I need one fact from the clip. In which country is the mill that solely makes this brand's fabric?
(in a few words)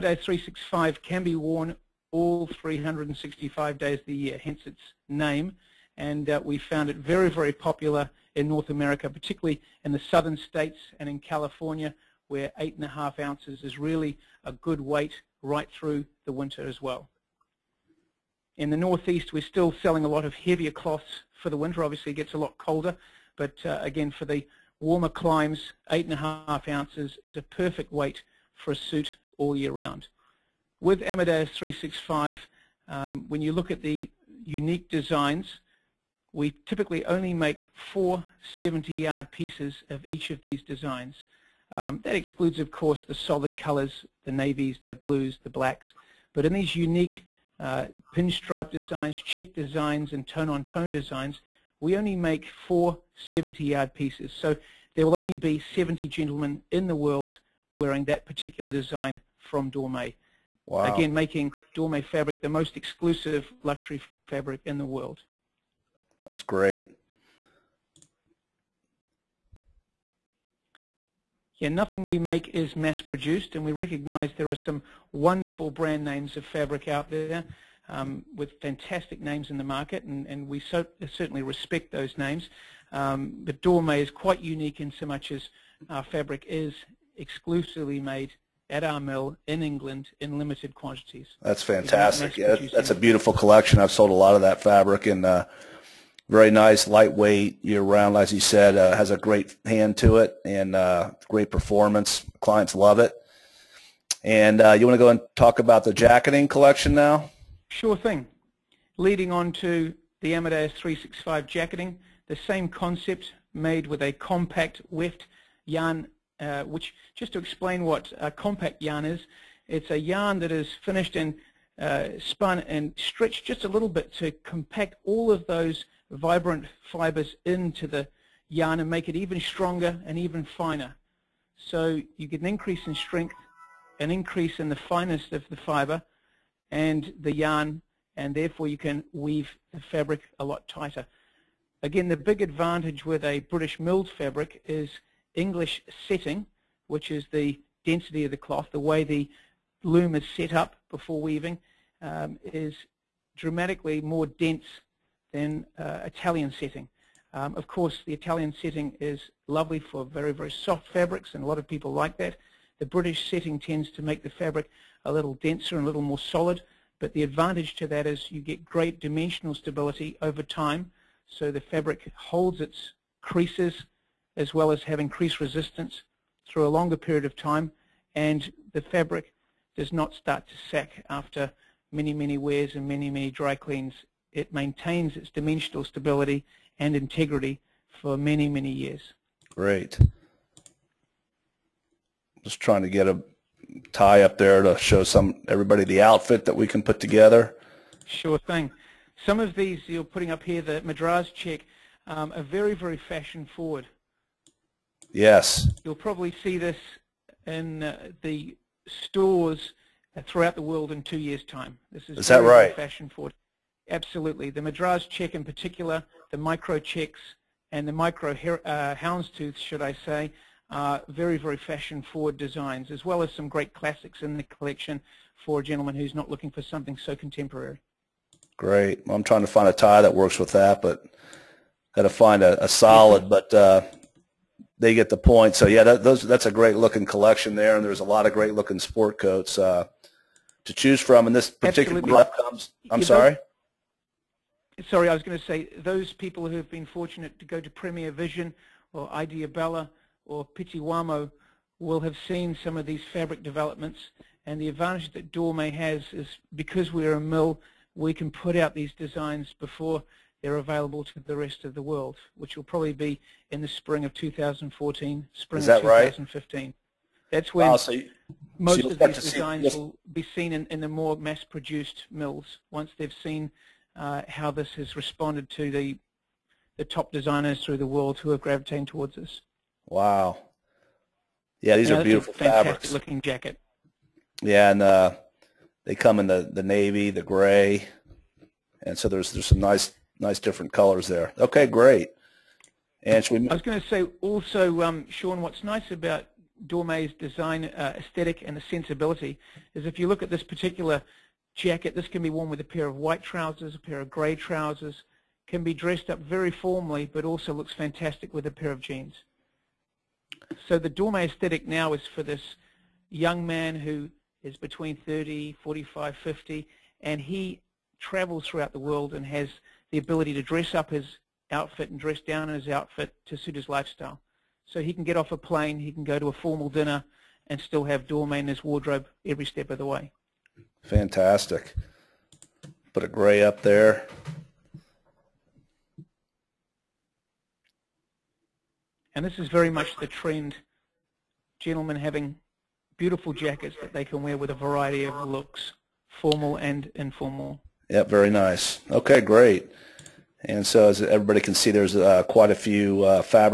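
England.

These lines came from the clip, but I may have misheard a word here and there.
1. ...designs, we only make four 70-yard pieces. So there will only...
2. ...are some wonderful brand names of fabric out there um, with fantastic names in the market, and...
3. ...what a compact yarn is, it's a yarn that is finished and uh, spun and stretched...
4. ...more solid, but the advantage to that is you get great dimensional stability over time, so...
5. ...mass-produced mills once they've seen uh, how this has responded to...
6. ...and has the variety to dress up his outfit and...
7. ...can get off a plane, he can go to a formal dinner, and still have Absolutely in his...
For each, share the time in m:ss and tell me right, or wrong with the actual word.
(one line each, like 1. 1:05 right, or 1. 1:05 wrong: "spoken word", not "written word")
1. 0:50 right
2. 1:14 right
3. 1:57 right
4. 2:46 right
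5. 4:31 right
6. 5:19 wrong: "ability", not "variety"
7. 5:24 wrong: "Dormeuil", not "Absolutely".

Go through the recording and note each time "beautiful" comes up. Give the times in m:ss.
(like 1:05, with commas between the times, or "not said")
1:32, 4:42, 5:42.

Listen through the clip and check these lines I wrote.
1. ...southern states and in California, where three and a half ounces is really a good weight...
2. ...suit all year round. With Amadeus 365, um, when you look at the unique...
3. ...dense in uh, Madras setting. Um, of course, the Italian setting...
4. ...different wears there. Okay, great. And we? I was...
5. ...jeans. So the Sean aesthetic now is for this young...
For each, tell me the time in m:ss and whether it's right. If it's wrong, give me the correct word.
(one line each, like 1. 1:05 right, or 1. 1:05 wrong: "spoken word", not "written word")
1. 0:10 wrong: "eight", not "three"
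2. 0:28 right
3. 2:34 wrong: "Italian", not "Madras"
4. 4:50 wrong: "colors", not "wears"
5. 5:08 wrong: "Dormeuil", not "Sean".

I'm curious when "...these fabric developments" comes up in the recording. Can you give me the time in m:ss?
4:12.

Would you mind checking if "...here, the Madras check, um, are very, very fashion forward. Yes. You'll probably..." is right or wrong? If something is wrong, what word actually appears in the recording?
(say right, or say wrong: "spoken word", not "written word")
right.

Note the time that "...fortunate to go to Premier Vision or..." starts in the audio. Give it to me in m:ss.
4:06.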